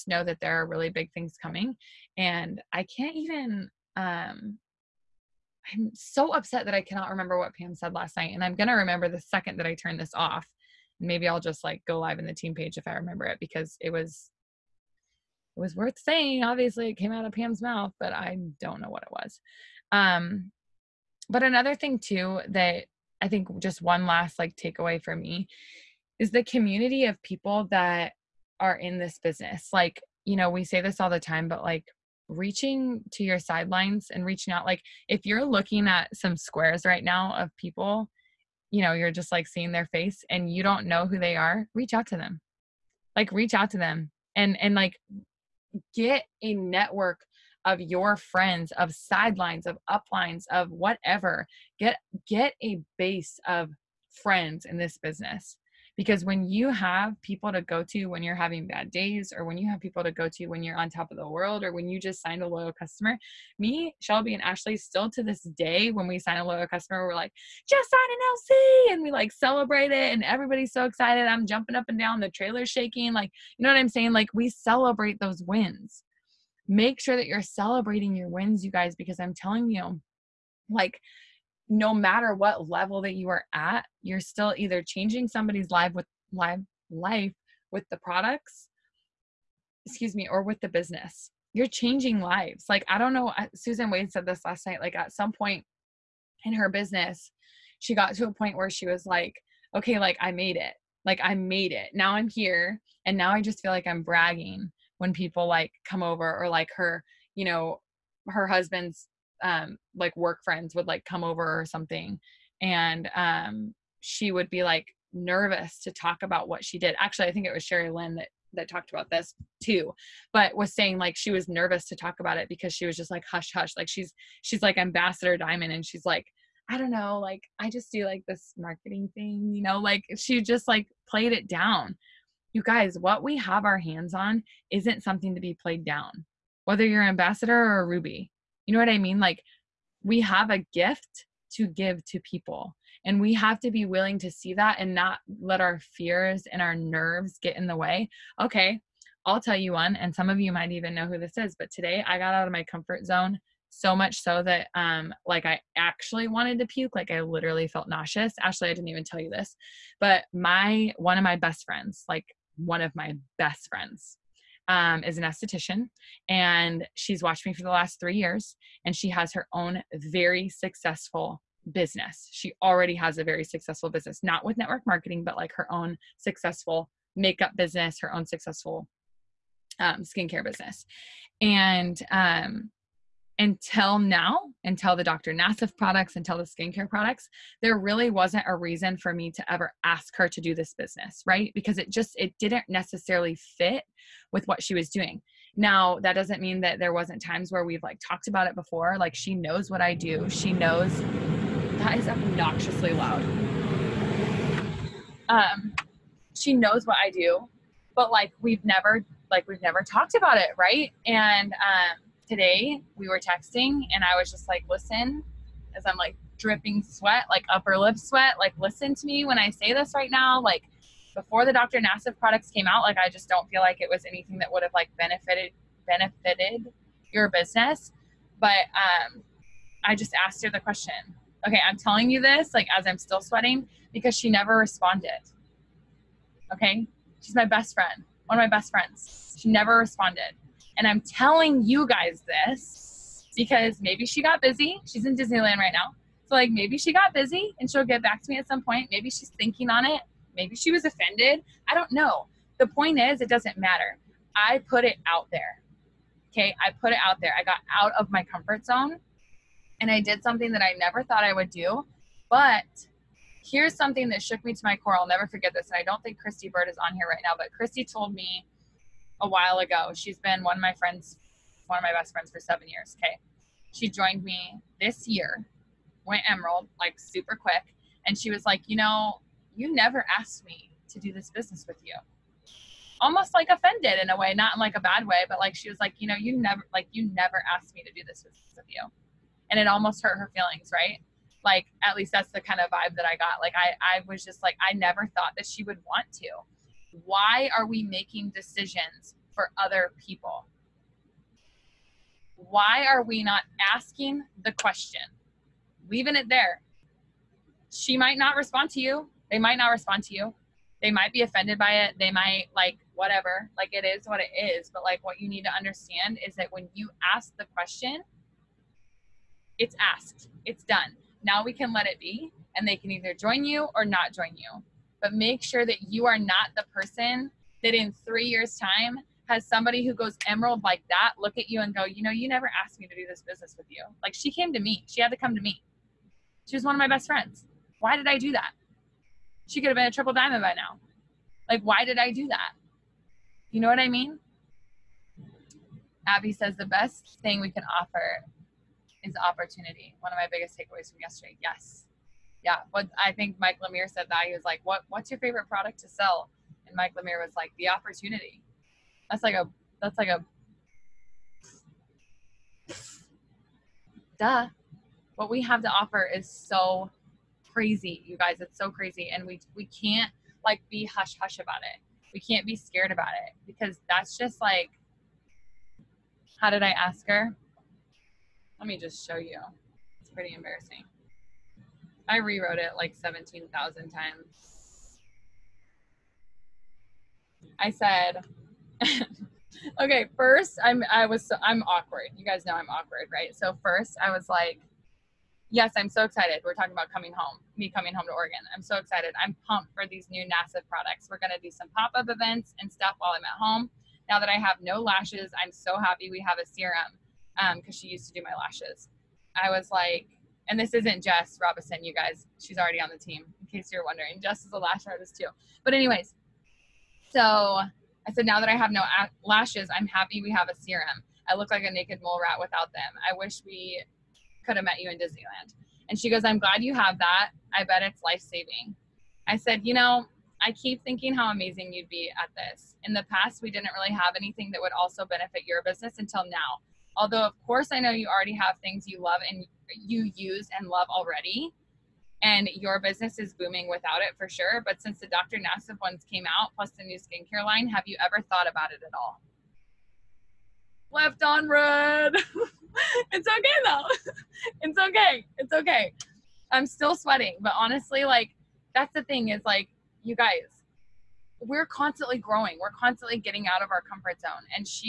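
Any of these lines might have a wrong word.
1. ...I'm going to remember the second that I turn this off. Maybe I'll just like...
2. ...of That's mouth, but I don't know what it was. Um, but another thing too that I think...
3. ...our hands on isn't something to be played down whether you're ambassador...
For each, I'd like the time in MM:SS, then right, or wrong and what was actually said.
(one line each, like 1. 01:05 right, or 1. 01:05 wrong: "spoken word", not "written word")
1. 00:08 right
2. 00:17 wrong: "Pam", not "That"
3. 02:13 right.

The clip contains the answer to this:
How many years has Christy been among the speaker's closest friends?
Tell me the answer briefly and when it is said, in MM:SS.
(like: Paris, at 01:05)
7, at 04:32.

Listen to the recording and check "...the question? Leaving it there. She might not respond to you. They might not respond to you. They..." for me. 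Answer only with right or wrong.
right.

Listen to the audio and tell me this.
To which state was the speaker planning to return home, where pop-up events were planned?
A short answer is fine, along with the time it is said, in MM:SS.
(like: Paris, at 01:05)
Oregon, at 06:38.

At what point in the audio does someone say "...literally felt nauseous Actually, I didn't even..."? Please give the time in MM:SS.
02:37.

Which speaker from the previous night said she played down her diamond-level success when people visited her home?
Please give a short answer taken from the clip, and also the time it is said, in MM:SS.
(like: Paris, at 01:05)
Sherry Lynn, at 01:57.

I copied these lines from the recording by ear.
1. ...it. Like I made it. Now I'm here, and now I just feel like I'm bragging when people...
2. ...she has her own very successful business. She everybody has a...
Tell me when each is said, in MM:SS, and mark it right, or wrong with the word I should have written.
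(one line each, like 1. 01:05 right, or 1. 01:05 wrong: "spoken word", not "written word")
1. 01:40 right
2. 02:48 wrong: "already", not "everybody".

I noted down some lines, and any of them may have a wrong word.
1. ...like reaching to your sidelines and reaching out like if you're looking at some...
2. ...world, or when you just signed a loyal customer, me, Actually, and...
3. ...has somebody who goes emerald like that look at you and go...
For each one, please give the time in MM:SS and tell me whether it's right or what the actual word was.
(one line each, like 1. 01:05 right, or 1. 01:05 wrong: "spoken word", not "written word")
1. 00:31 right
2. 01:01 wrong: "Shelby", not "Actually"
3. 05:29 right.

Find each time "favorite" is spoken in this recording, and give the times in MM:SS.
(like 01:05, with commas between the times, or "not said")
05:55.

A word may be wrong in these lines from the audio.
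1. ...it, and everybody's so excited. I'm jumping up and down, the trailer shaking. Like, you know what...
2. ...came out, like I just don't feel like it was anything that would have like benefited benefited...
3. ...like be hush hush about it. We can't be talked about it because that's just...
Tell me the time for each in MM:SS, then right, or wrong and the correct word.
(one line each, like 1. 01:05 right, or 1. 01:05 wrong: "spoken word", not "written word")
1. 01:09 right
2. 03:42 right
3. 06:10 wrong: "scared", not "talked".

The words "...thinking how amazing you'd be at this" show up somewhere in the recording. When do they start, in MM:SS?
07:10.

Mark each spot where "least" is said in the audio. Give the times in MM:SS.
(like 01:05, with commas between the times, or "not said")
04:51.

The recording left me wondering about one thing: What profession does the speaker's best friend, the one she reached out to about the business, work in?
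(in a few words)
esthetician.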